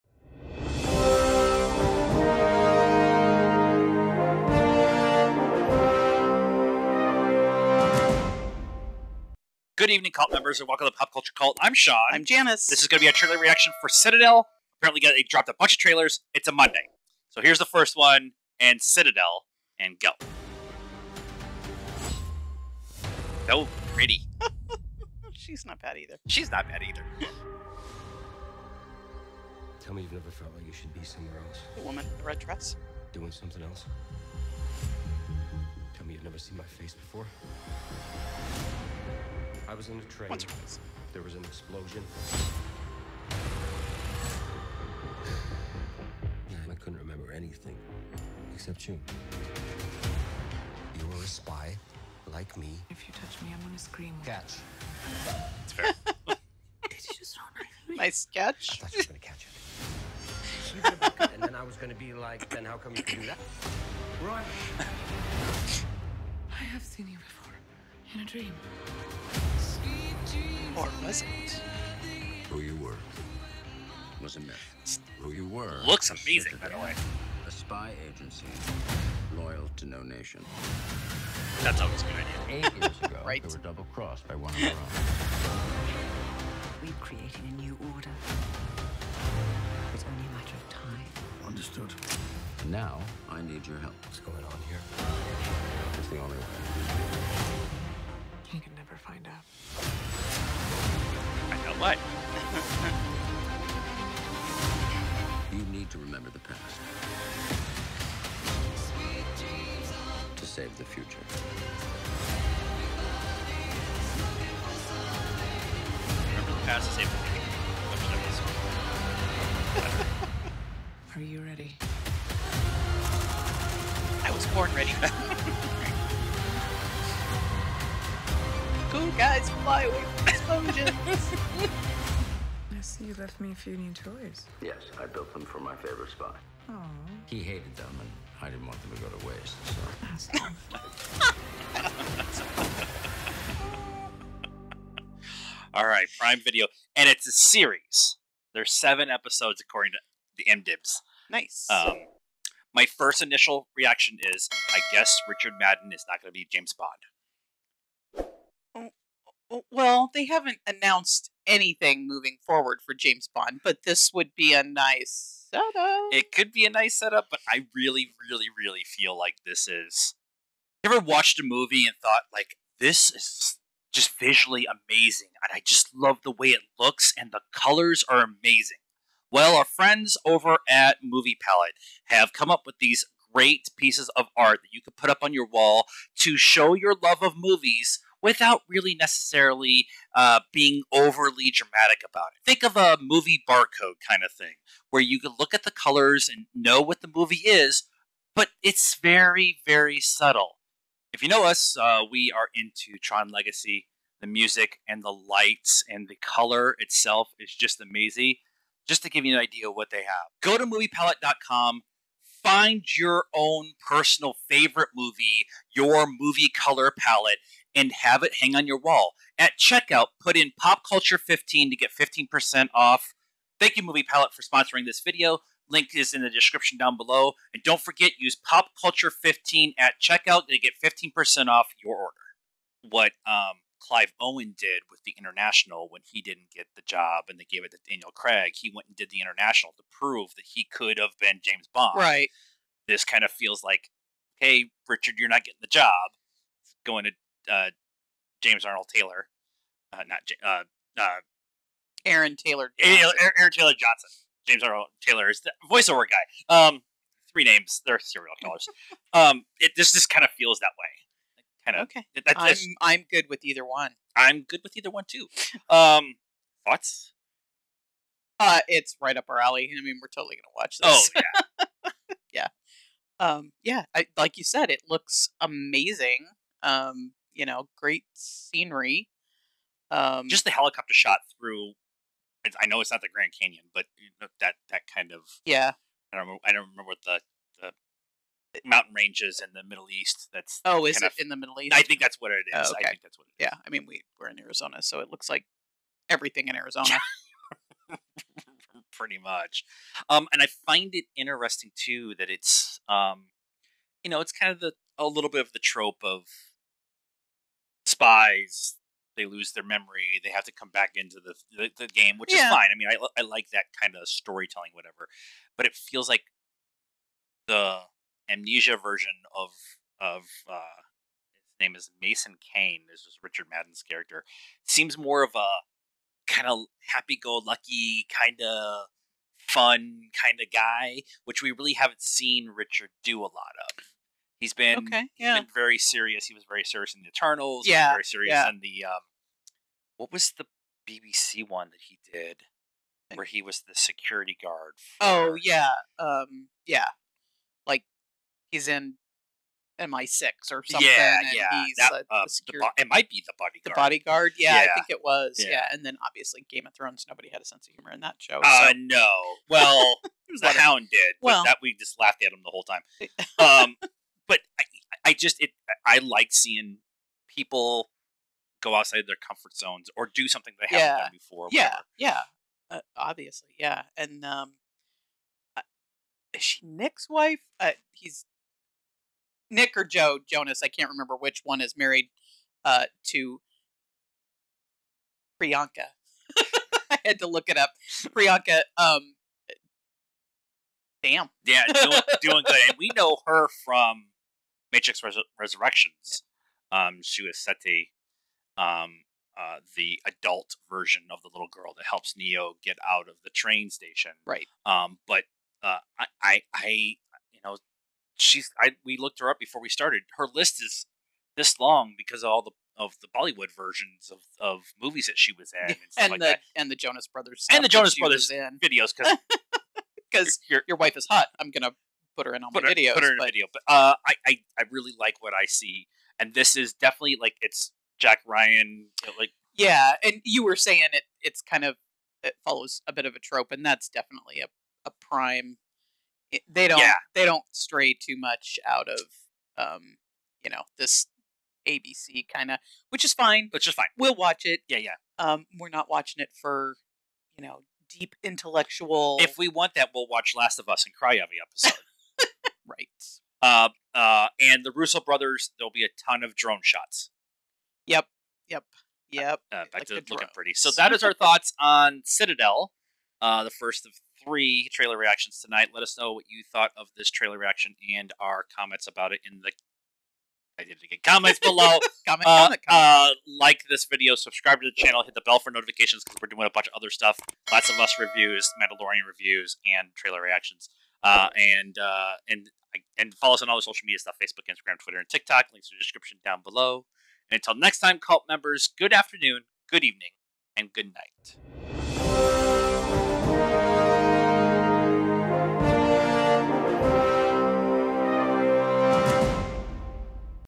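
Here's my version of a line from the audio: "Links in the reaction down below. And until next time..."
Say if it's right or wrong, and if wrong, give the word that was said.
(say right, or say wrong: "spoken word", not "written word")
wrong: "description", not "reaction".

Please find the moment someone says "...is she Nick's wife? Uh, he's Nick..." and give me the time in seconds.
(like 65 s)
376 s.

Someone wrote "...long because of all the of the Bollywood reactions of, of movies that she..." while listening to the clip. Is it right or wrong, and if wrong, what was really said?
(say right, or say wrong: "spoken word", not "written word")
wrong: "versions", not "reactions".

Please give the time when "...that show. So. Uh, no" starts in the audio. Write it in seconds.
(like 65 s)
358 s.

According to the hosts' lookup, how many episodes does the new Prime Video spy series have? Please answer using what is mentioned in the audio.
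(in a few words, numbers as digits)
7.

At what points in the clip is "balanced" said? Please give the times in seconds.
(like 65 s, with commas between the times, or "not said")
not said.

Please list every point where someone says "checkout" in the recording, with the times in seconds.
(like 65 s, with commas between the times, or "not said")
219 s, 230 s.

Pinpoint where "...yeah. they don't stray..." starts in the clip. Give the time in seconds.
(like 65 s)
436 s.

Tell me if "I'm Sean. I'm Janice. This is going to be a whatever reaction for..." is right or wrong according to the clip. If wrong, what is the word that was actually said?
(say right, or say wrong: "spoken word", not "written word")
wrong: "trailer", not "whatever".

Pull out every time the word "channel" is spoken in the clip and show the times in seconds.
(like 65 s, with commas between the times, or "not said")
474 s.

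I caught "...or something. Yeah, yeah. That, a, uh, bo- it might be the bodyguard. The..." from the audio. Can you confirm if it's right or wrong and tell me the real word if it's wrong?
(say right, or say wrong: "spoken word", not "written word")
right.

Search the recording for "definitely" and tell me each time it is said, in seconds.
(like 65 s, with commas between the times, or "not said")
426 s, 433 s.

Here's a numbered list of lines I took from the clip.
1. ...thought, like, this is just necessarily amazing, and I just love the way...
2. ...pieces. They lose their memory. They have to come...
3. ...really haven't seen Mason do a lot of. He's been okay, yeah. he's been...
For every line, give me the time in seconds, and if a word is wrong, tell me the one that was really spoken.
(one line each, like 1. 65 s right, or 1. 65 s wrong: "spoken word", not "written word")
1. 172 s wrong: "visually", not "necessarily"
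2. 307 s wrong: "spies", not "pieces"
3. 331 s wrong: "Richard", not "Mason".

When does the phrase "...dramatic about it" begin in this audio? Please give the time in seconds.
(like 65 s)
191 s.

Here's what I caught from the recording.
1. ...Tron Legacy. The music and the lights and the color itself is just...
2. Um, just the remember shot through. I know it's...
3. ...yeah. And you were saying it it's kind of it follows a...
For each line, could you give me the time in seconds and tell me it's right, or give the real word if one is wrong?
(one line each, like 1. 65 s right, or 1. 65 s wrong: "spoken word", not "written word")
1. 203 s right
2. 279 s wrong: "helicopter", not "remember"
3. 429 s right.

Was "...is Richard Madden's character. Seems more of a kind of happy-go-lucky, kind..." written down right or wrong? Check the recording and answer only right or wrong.
right.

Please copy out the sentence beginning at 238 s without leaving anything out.
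He went and did the International to prove that he could have been James Bond.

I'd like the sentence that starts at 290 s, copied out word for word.
That's oh, is it of, in the Middle East?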